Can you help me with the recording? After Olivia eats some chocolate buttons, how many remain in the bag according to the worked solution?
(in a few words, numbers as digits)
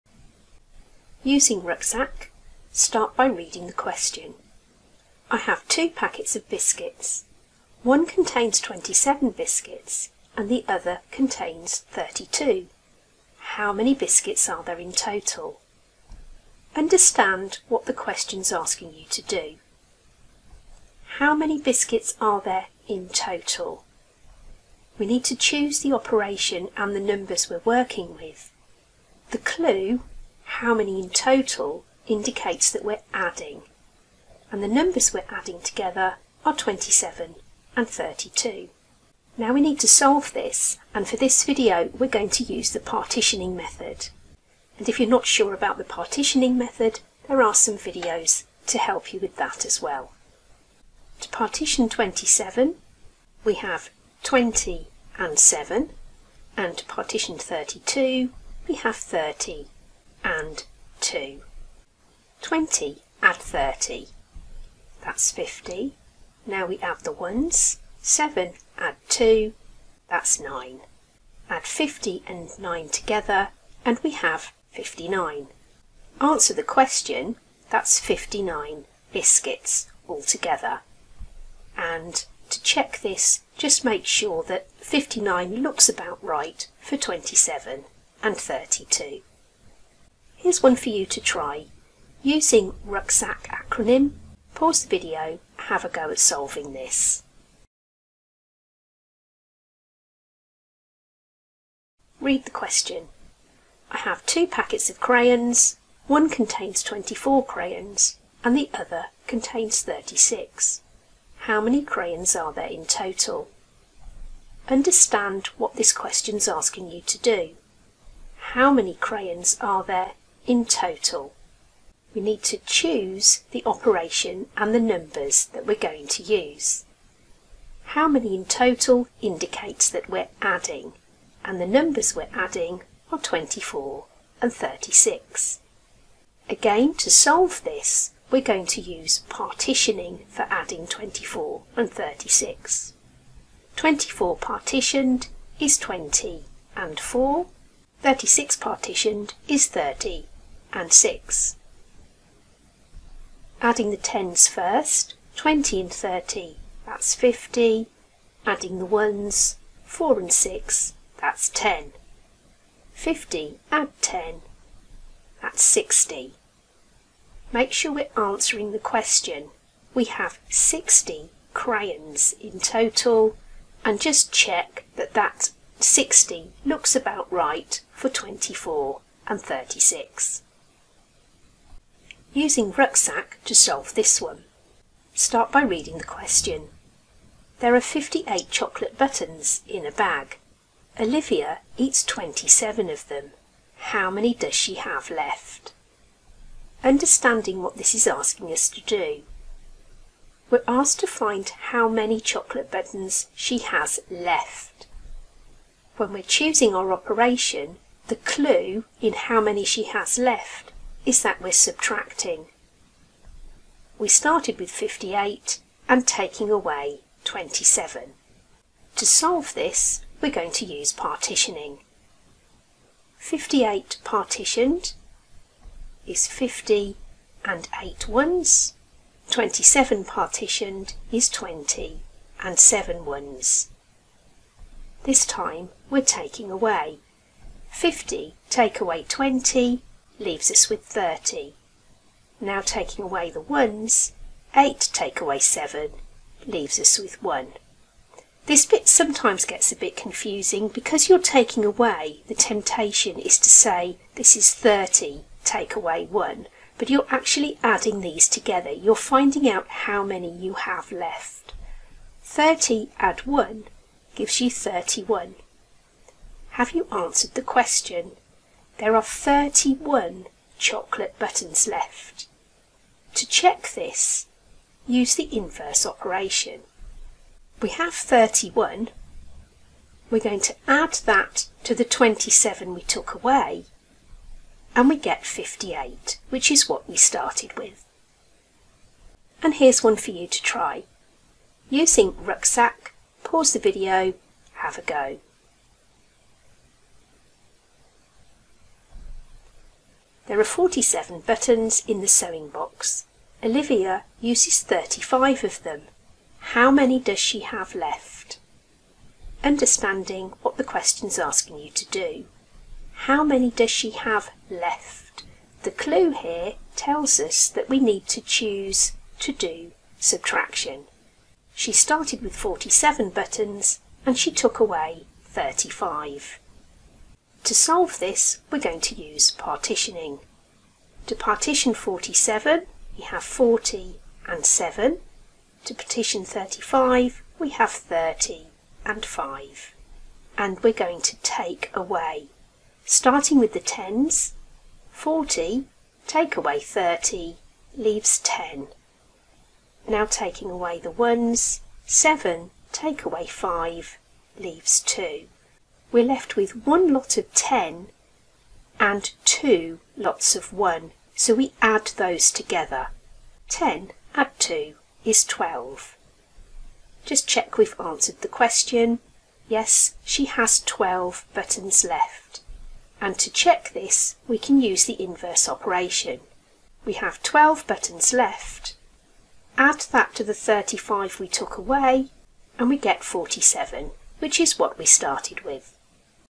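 31.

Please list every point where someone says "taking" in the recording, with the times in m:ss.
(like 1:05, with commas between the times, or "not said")
3:36, 3:56, 4:02, 4:11, 5:50.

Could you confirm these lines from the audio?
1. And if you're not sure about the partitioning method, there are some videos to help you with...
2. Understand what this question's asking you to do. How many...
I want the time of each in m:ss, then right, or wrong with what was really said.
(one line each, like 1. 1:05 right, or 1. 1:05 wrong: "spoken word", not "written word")
1. 0:44 right
2. 1:54 right.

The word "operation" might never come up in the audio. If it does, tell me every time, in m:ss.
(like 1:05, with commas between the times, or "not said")
0:25, 2:03, 3:26, 4:35, 6:15.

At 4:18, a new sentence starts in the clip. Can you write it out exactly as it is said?
You're finding out how many you have left.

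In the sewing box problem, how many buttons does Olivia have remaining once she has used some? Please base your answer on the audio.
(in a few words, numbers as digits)
12.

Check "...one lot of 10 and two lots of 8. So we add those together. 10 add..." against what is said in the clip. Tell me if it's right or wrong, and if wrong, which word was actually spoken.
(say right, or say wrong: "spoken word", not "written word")
wrong: "1", not "8".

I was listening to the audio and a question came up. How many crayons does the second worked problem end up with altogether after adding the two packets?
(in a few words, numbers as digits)
60.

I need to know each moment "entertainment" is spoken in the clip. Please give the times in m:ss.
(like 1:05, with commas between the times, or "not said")
not said.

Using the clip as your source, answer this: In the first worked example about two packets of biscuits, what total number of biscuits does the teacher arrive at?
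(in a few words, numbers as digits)
59.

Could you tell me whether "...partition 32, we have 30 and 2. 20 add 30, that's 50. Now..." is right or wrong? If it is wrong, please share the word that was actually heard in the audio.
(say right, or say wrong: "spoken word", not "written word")
right.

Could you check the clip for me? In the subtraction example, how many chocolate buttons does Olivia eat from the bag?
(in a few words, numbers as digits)
27.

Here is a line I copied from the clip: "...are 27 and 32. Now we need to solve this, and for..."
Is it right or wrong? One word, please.
right.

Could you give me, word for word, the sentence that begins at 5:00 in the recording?
There are 47 buttons in the sewing box.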